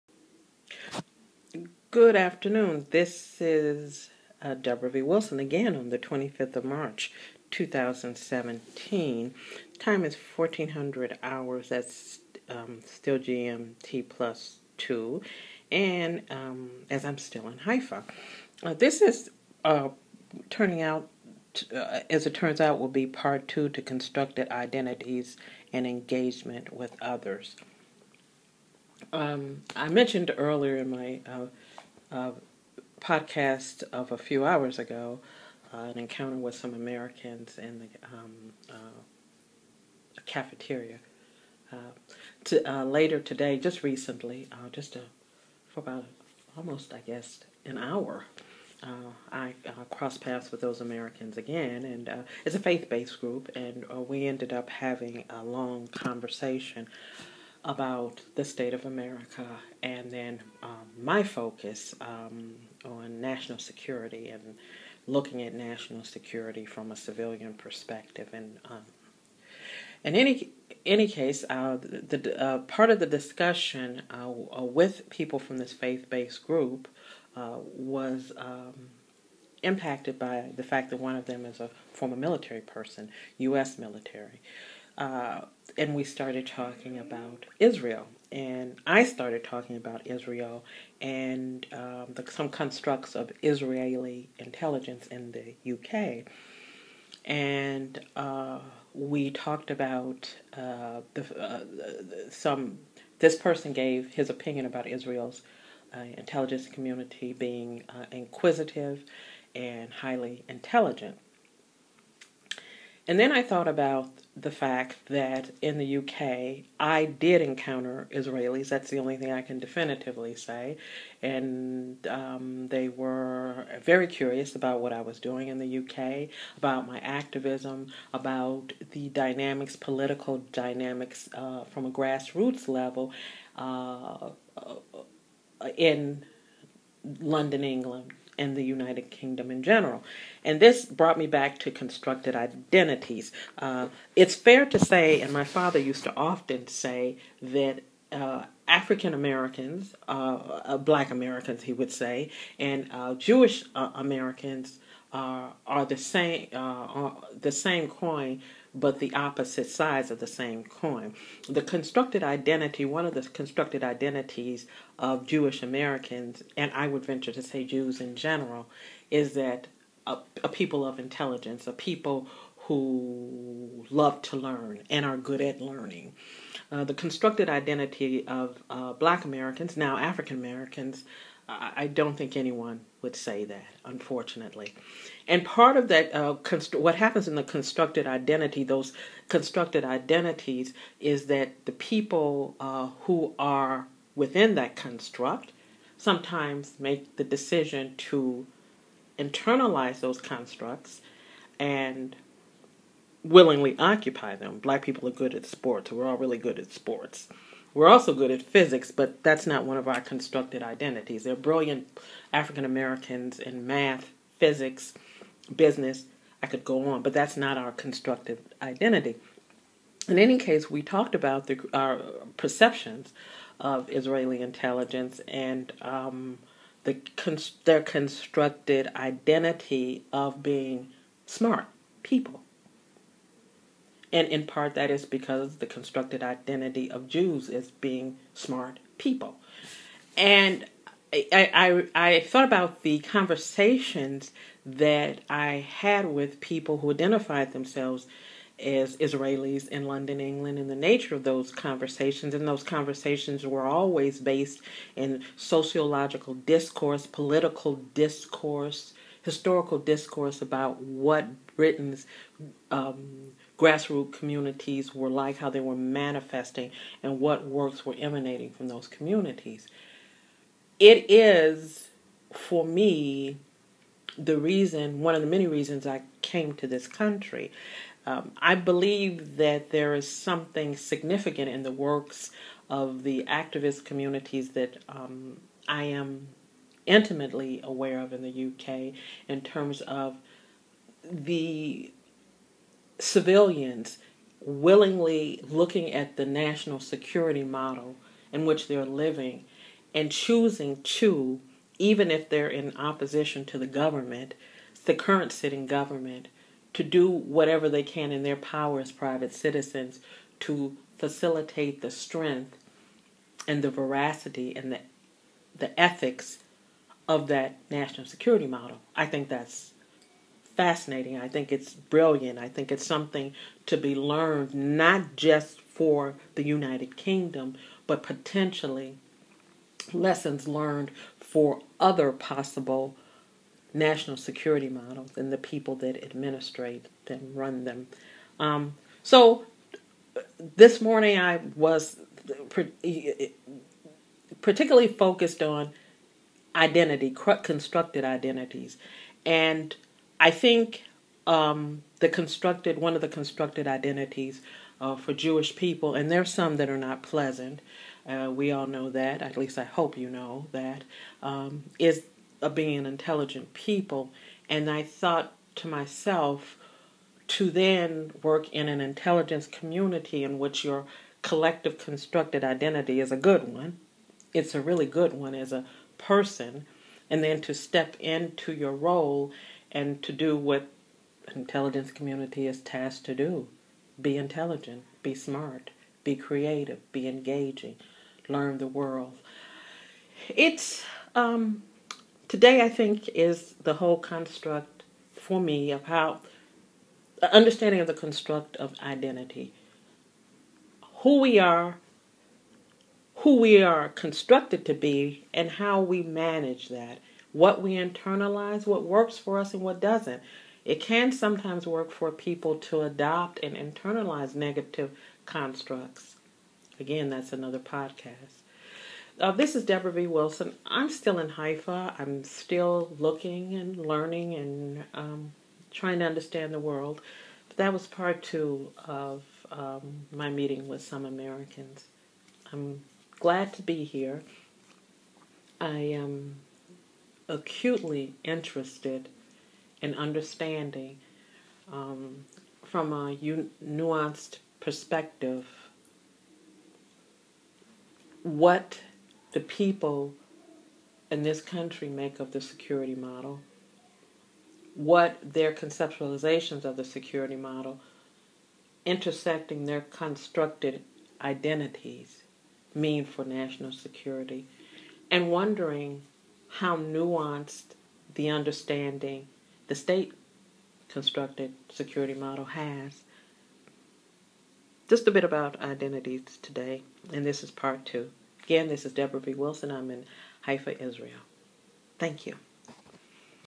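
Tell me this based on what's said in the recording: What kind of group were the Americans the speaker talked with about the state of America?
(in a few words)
faith-based group.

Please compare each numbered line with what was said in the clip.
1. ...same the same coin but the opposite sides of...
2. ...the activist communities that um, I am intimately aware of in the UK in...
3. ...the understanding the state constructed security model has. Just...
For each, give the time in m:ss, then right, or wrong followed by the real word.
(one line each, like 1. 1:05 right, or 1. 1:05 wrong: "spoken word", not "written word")
1. 2:35 right
2. 4:43 right
3. 7:48 right.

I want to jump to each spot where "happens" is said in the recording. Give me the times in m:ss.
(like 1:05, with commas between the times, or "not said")
3:06.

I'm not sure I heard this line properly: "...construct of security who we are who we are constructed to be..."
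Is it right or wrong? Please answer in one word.
wrong.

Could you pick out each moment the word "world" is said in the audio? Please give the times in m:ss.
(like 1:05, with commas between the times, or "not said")
6:28, 7:06.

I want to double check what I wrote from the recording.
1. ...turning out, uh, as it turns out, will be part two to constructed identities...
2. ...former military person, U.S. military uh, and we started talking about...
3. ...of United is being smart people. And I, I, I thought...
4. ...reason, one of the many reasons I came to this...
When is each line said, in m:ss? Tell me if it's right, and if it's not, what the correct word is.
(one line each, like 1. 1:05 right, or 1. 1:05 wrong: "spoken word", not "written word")
1. 0:20 right
2. 1:21 right
3. 3:56 wrong: "Jews", not "United"
4. 4:34 right.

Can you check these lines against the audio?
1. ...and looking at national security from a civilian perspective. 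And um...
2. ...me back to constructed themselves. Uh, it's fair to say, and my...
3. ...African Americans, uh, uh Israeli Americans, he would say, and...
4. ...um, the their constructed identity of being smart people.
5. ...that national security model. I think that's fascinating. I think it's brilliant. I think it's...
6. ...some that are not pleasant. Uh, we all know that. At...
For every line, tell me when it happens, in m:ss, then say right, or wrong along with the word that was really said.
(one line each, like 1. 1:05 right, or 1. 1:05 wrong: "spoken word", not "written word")
1. 1:04 right
2. 2:21 wrong: "identities", not "themselves"
3. 2:28 wrong: "Black", not "Israeli"
4. 3:45 right
5. 5:17 right
6. 5:56 right.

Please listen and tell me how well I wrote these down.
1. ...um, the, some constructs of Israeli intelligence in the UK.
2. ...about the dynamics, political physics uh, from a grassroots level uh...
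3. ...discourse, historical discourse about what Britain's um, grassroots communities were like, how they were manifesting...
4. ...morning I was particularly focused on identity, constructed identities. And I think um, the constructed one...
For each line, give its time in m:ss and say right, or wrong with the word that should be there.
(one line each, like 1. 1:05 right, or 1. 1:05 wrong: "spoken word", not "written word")
1. 1:31 right
2. 2:08 wrong: "dynamics", not "physics"
3. 4:17 right
4. 5:40 right.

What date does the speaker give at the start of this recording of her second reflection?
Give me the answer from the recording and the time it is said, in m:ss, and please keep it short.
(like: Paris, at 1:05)
25 March 2017, at 0:05.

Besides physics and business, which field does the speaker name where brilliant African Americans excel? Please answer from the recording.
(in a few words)
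math.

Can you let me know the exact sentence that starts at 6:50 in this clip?
It can sometimes work for people to adopt and internalize negative constructs.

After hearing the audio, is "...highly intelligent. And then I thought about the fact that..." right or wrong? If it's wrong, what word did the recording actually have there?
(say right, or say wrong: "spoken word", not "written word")
right.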